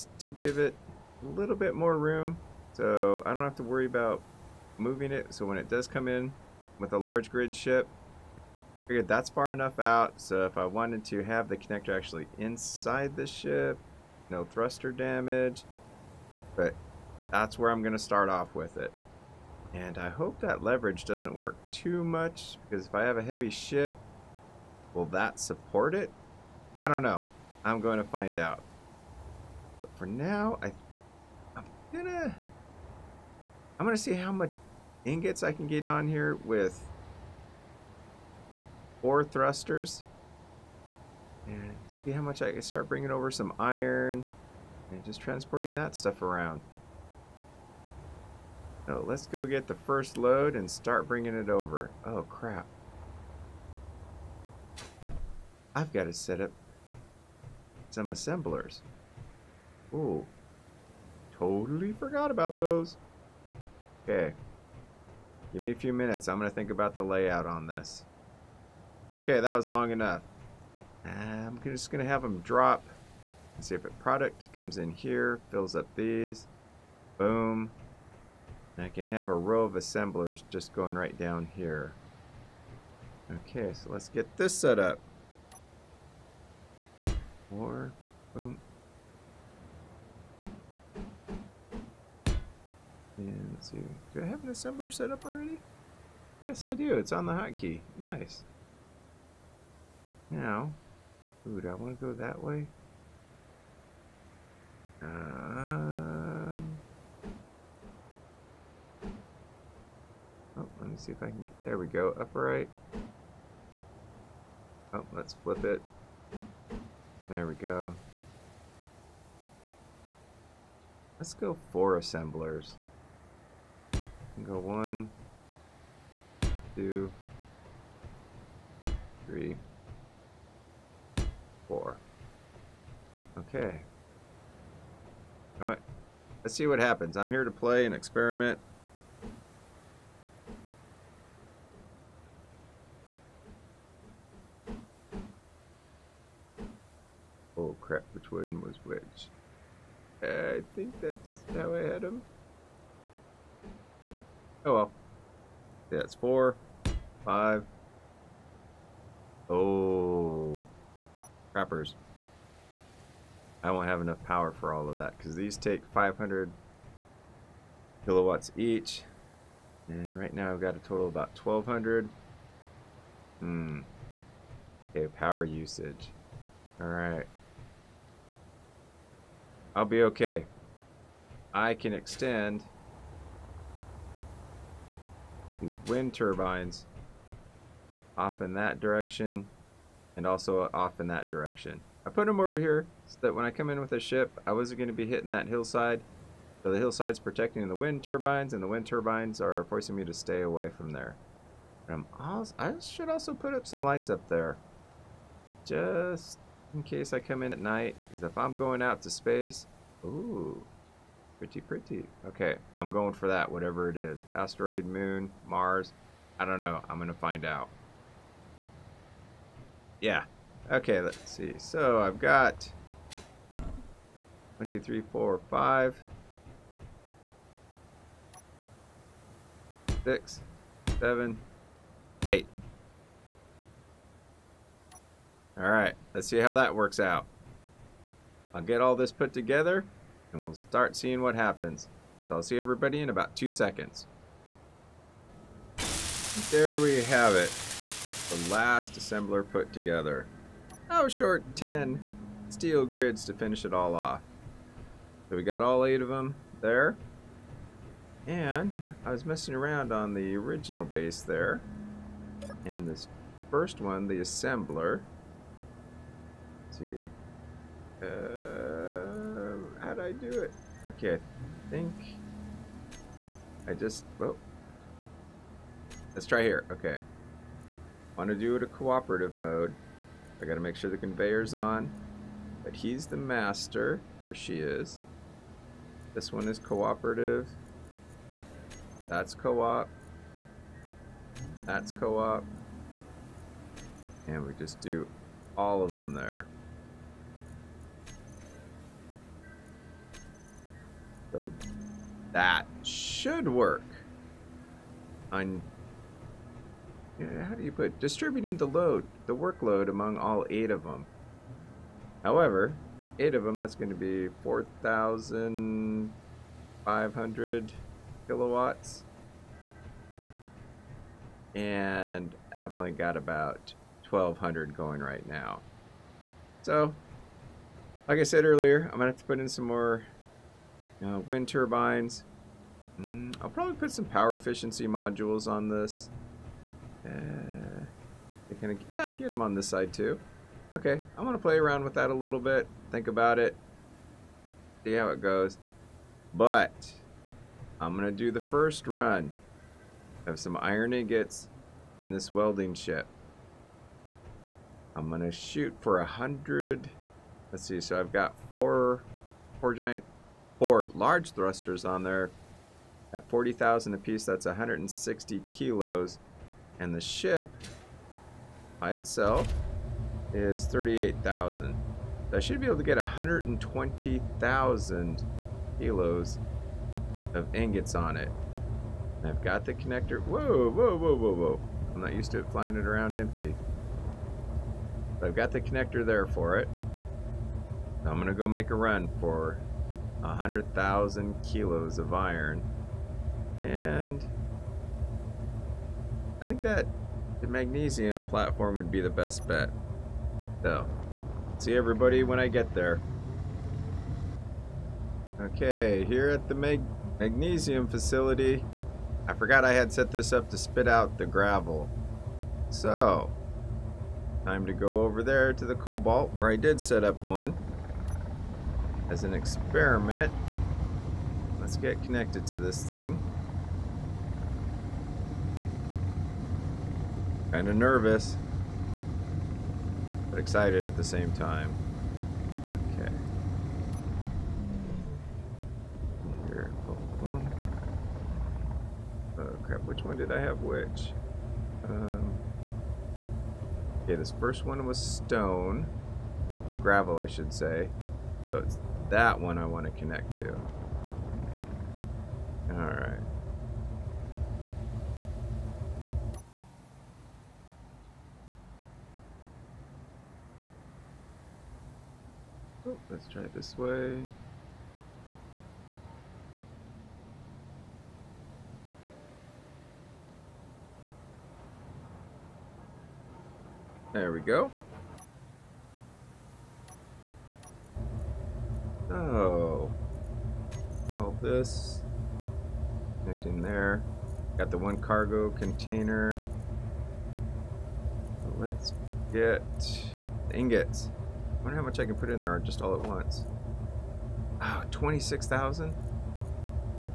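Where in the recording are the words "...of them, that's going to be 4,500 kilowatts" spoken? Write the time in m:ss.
5:13.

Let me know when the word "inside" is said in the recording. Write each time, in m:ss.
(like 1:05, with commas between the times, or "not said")
0:12.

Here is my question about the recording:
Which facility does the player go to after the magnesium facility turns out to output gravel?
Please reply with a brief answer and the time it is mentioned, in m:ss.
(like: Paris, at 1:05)
The cobalt, at 6:55.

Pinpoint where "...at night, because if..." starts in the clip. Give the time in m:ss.
3:27.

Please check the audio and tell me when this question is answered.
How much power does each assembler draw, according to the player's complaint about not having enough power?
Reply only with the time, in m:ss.
2:45.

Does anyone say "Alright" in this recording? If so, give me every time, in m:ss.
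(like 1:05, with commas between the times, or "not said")
2:56, 7:32.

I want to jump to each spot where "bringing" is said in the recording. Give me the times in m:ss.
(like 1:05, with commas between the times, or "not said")
0:42, 0:51.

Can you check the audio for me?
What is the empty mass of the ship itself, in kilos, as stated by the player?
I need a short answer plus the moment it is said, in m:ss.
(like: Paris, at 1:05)
38,000, at 6:10.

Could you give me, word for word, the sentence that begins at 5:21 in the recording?
And I've only got about 1,200 going right now.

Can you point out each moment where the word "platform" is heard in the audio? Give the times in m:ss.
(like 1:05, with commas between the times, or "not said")
6:38.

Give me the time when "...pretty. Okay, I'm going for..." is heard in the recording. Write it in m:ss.
3:31.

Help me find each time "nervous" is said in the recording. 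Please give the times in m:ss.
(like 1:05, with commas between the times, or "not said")
7:07.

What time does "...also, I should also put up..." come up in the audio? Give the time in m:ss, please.
3:22.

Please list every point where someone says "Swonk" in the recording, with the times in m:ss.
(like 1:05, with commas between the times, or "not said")
not said.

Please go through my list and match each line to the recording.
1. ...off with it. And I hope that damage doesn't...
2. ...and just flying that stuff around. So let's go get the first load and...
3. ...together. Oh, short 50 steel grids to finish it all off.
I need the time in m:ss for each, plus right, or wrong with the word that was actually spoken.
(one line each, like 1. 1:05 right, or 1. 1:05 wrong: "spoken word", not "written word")
1. 0:18 wrong: "leverage", not "damage"
2. 0:44 wrong: "transporting", not "flying"
3. 4:09 wrong: "10", not "50".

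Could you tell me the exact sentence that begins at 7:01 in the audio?
Let's get connected to this thing.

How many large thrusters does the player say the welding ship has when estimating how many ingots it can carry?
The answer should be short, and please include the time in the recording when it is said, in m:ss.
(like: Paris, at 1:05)
4, at 0:39.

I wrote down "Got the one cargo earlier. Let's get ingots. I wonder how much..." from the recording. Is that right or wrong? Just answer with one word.
wrong.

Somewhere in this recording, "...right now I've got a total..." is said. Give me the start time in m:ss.
2:50.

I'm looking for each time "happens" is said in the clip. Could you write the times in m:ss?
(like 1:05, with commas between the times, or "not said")
2:16, 4:01.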